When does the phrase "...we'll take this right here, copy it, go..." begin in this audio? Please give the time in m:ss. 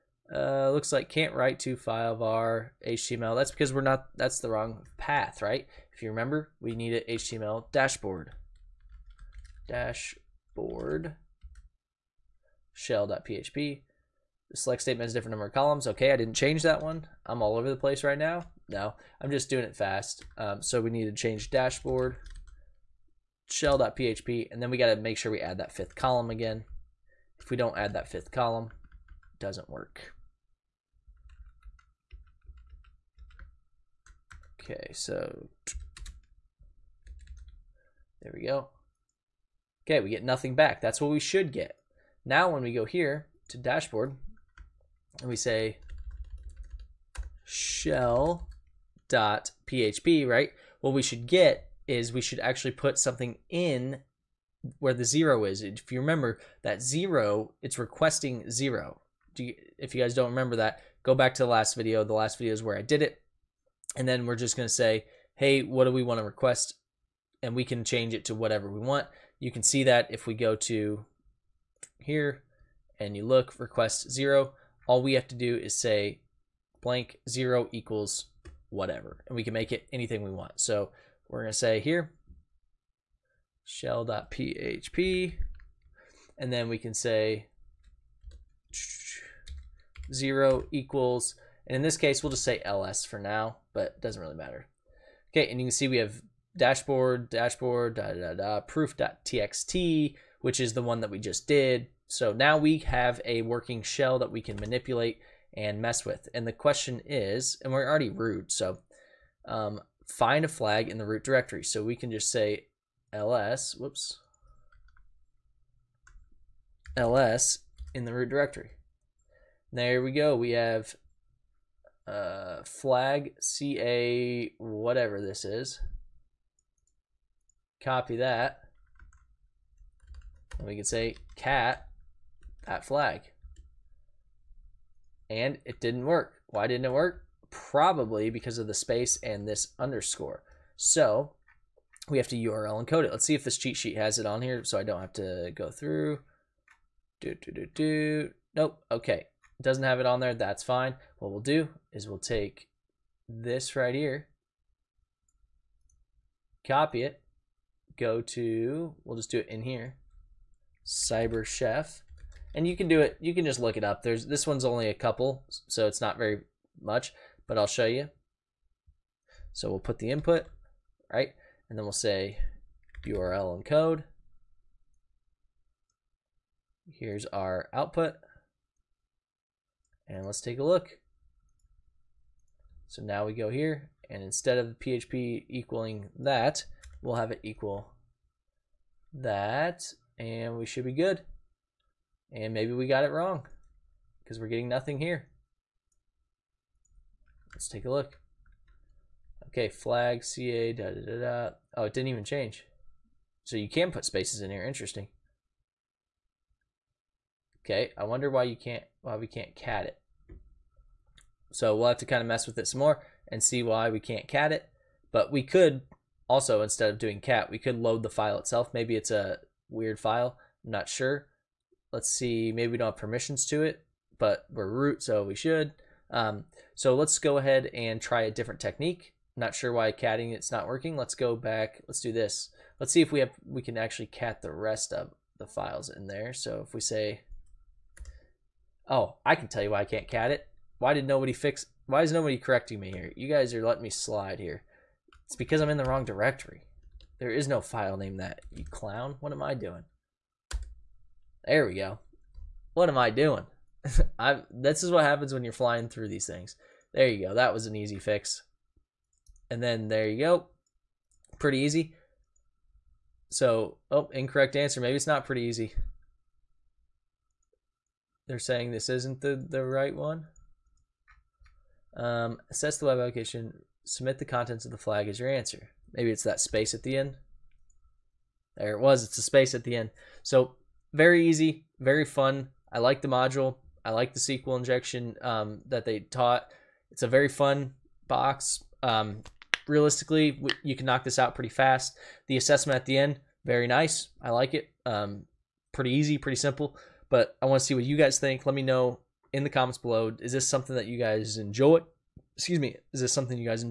2:32.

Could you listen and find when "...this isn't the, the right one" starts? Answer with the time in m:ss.
4:28.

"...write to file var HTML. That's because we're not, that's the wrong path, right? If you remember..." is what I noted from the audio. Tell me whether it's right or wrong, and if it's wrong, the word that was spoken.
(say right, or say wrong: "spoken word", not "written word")
right.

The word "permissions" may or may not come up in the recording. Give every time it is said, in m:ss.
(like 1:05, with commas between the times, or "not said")
3:42.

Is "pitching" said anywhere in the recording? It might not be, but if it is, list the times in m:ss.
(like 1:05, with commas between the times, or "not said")
not said.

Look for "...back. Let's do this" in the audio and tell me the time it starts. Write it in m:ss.
3:51.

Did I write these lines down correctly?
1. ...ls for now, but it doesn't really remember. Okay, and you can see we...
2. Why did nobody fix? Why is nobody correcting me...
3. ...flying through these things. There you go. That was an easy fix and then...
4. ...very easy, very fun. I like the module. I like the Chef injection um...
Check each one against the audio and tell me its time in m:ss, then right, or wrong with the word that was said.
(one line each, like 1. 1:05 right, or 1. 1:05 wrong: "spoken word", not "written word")
1. 1:32 wrong: "matter", not "remember"
2. 4:00 right
3. 4:15 right
4. 4:40 wrong: "SQL", not "Chef".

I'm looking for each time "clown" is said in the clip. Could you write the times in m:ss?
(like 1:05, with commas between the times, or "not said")
4:08.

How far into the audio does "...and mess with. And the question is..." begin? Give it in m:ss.
1:45.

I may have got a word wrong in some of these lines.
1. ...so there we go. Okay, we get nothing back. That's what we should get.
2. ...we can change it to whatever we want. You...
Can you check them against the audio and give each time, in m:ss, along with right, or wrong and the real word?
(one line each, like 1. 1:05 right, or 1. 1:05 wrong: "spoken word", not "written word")
1. 0:34 right
2. 1:07 right.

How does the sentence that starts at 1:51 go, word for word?
So we can just say ls, whoops, ls in the root directory.